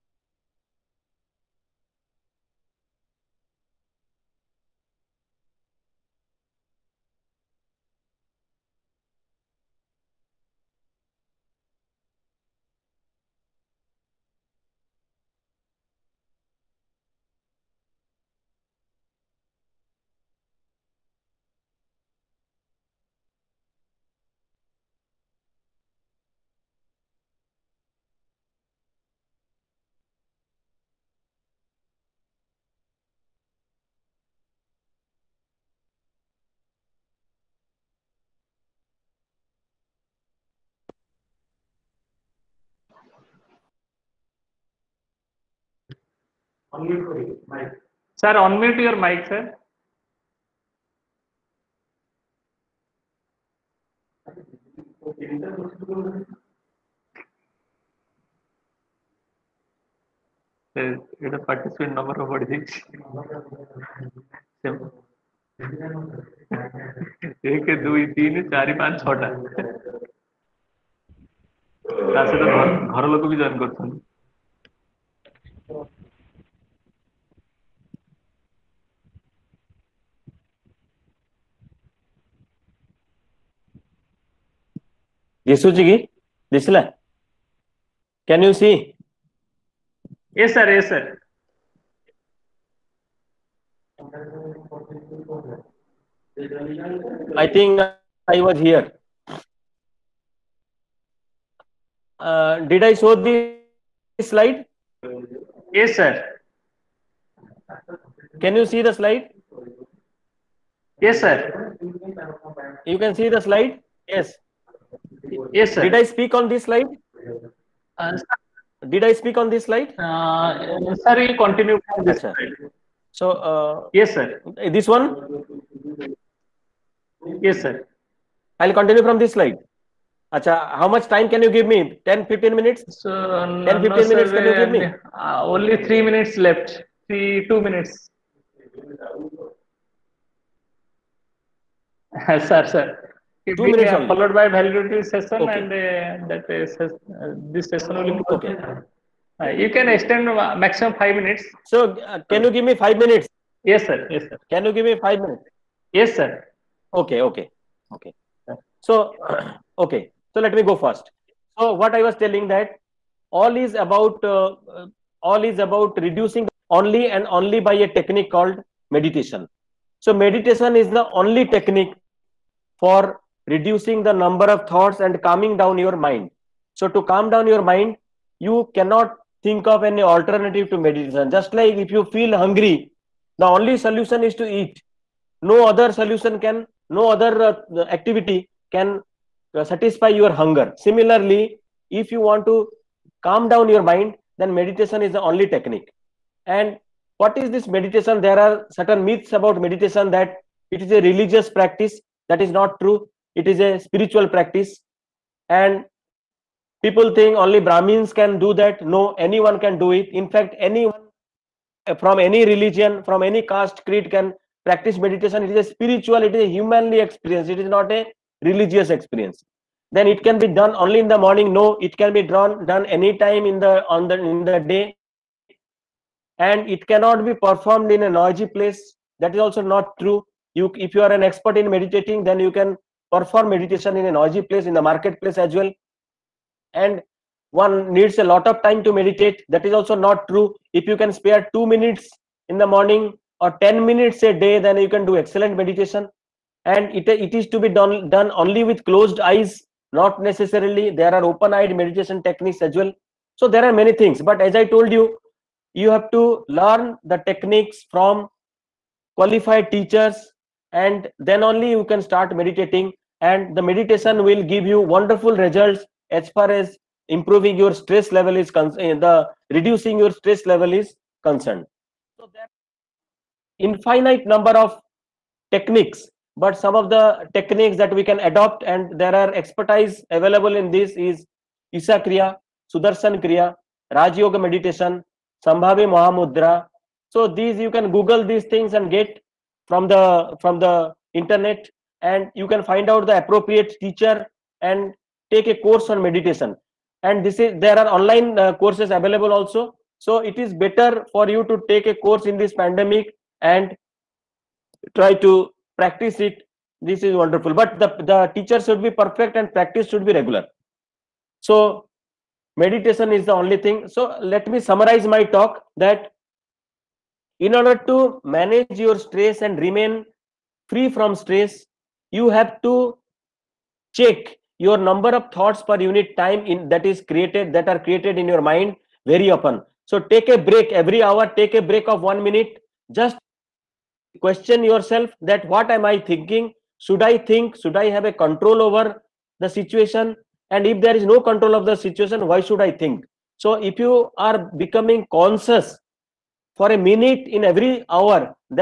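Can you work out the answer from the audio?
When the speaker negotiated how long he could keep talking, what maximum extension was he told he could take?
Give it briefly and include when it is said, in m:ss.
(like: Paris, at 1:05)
5 minutes, at 2:30.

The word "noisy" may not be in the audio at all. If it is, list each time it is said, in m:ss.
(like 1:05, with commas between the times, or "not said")
3:48, 3:54.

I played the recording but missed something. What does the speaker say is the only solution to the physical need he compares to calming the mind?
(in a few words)
to eat.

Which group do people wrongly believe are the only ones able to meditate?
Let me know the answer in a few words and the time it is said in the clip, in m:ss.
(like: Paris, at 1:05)
Brahmins, at 3:27.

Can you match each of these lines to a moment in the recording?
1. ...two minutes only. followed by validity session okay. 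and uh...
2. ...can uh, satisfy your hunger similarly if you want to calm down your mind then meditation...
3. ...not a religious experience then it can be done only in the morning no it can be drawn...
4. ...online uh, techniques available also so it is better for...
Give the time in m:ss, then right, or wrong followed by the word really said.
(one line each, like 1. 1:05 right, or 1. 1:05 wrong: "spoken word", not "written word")
1. 2:23 right
2. 3:08 right
3. 3:37 right
4. 4:57 wrong: "courses", not "techniques".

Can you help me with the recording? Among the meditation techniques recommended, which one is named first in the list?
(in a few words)
Isha Kriya.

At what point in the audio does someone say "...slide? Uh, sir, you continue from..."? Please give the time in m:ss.
1:59.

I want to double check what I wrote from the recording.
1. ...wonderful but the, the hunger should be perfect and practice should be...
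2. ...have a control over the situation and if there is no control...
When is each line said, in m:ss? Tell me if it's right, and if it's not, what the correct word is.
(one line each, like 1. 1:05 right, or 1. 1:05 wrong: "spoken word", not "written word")
1. 5:07 wrong: "teacher", not "hunger"
2. 5:37 right.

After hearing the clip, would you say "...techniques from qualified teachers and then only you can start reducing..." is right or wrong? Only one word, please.
wrong.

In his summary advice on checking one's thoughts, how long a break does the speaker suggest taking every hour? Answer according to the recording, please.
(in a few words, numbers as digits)
1 minute.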